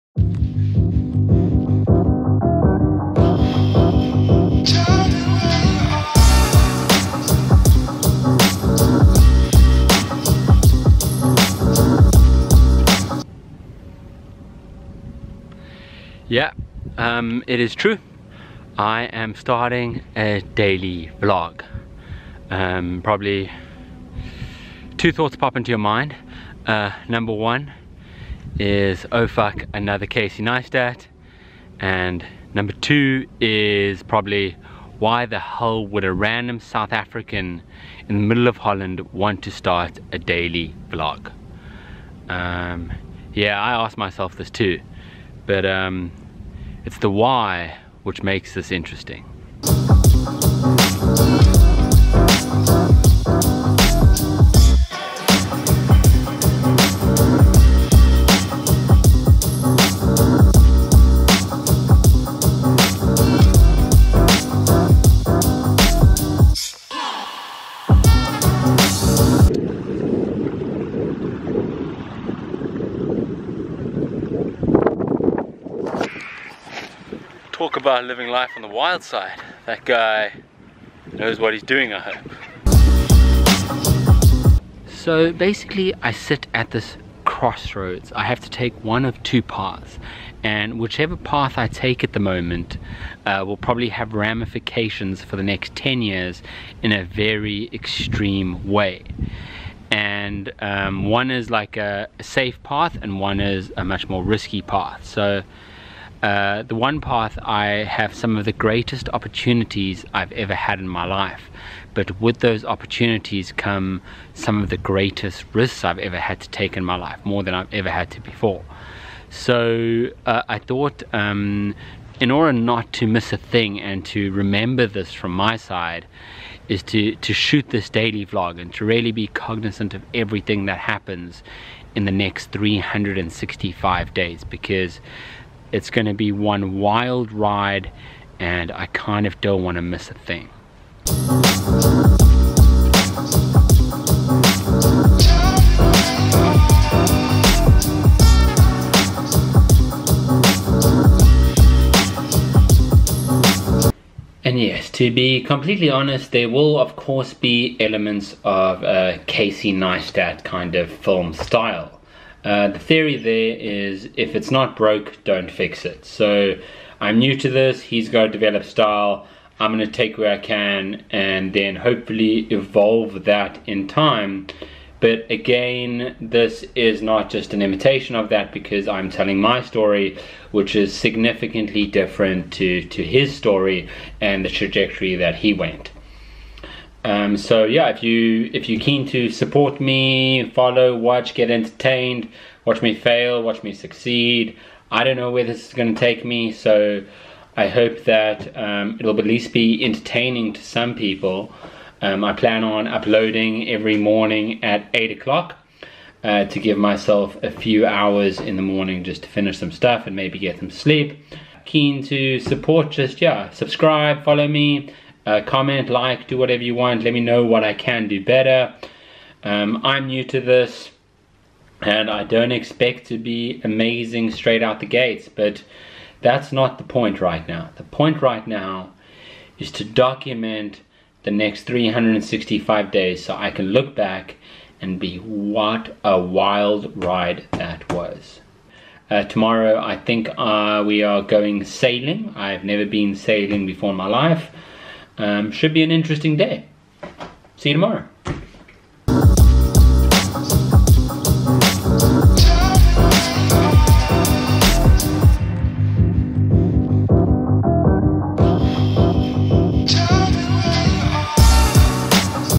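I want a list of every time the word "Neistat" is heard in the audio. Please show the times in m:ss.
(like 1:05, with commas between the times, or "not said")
0:30, 2:39.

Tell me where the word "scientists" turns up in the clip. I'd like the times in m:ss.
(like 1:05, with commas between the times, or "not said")
not said.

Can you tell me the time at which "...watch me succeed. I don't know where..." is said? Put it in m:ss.
3:13.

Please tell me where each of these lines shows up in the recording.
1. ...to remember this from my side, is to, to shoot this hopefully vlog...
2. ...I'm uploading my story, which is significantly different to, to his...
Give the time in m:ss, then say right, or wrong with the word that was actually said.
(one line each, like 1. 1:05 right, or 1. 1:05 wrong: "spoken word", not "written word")
1. 2:04 wrong: "daily", not "hopefully"
2. 2:58 wrong: "telling", not "uploading".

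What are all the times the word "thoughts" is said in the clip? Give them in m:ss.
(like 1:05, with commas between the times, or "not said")
0:25, 2:00.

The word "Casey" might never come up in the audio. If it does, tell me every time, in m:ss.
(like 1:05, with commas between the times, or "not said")
0:30, 2:39.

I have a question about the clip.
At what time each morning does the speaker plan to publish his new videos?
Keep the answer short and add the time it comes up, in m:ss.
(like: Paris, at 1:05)
8 o'clock, at 3:24.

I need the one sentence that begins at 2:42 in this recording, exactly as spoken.
Uh, the theory there is if it's not broke, don't fix it.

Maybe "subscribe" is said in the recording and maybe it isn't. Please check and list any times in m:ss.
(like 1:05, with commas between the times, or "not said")
3:33.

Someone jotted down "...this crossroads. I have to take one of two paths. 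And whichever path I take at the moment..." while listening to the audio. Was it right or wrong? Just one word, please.
right.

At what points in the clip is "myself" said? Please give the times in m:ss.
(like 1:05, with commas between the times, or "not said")
0:43, 3:26.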